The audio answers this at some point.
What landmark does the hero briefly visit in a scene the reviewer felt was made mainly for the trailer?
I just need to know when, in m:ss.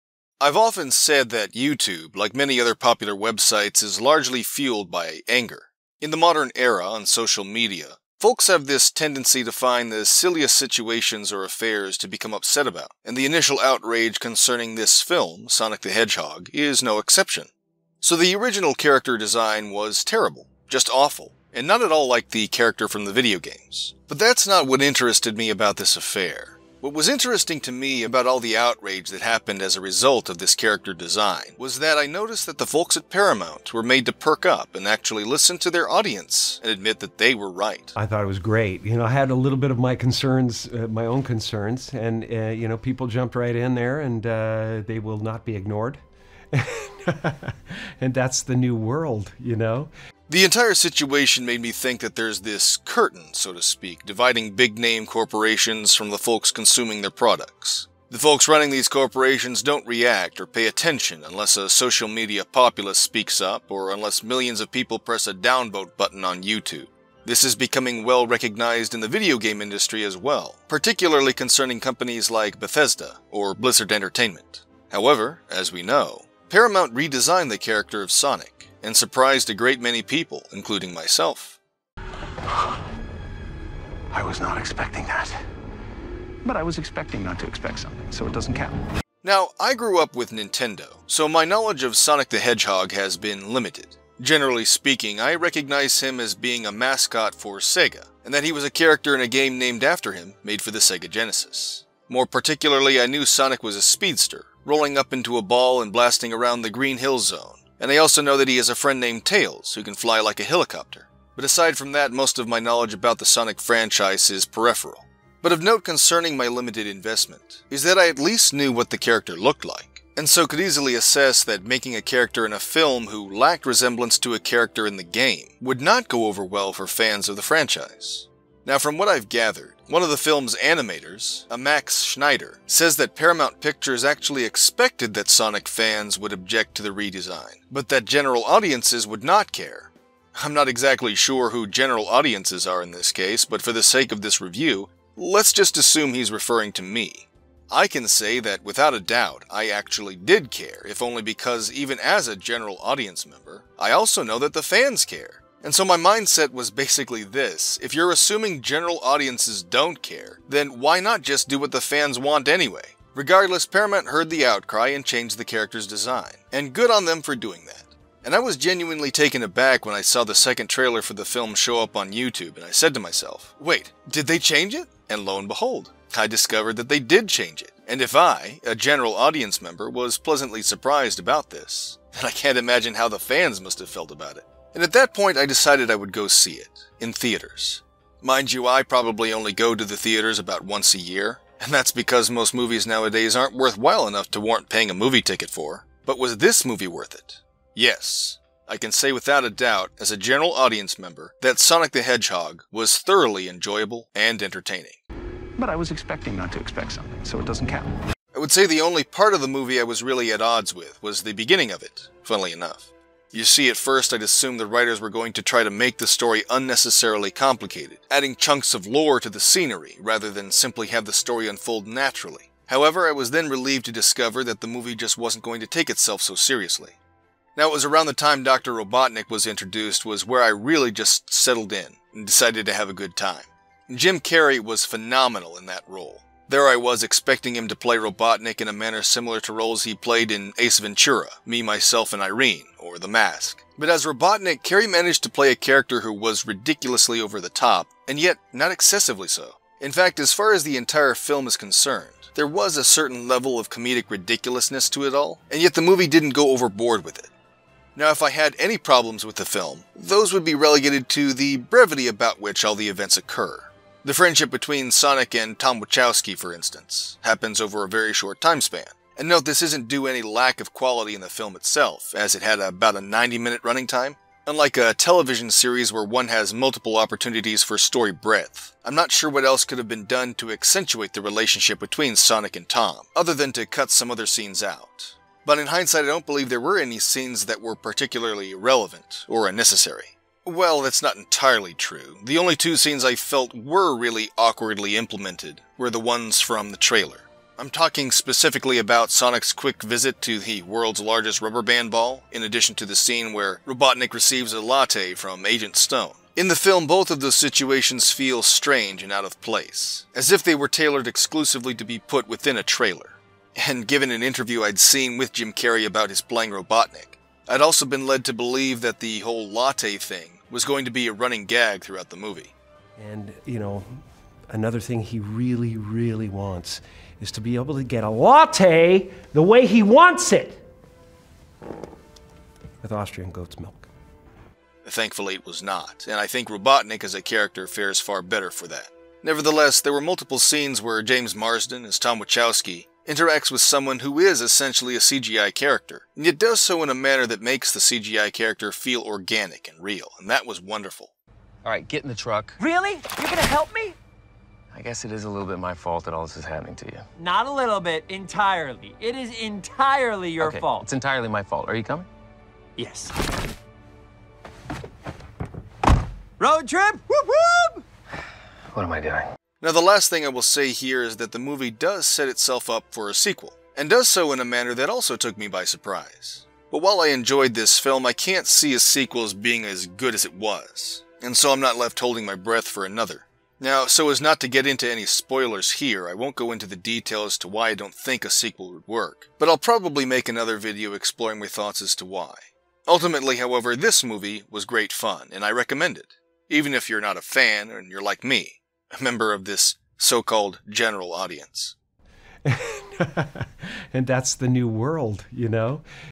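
5:00.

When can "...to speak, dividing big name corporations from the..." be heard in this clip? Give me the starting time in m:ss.
0:53.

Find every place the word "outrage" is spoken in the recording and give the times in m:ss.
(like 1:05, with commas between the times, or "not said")
0:13, 0:28.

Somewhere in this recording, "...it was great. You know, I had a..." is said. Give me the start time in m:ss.
0:38.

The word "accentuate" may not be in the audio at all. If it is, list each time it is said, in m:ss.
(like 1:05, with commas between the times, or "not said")
4:40.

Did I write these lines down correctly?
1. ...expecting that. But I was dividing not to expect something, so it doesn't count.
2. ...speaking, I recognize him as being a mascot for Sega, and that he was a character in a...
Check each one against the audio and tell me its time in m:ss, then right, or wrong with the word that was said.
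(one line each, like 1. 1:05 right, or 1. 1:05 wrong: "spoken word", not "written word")
1. 1:24 wrong: "expecting", not "dividing"
2. 1:34 right.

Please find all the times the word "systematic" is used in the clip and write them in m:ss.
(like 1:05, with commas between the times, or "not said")
not said.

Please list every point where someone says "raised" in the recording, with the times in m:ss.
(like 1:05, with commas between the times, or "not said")
not said.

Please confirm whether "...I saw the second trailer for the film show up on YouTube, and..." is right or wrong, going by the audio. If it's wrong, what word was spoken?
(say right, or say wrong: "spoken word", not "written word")
right.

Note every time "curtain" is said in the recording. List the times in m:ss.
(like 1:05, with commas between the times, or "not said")
0:52.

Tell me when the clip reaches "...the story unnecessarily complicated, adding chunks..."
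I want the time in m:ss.
3:35.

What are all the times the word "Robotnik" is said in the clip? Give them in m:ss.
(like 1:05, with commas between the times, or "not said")
3:48, 3:57, 4:04, 5:03, 5:16, 5:36.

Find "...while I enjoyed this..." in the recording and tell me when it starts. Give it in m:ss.
6:16.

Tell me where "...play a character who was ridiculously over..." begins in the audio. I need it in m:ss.
4:05.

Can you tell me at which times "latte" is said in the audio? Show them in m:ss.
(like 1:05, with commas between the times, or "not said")
5:04, 5:19, 5:28.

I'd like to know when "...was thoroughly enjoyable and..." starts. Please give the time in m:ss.
3:22.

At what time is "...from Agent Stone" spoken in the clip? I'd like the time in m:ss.
5:05.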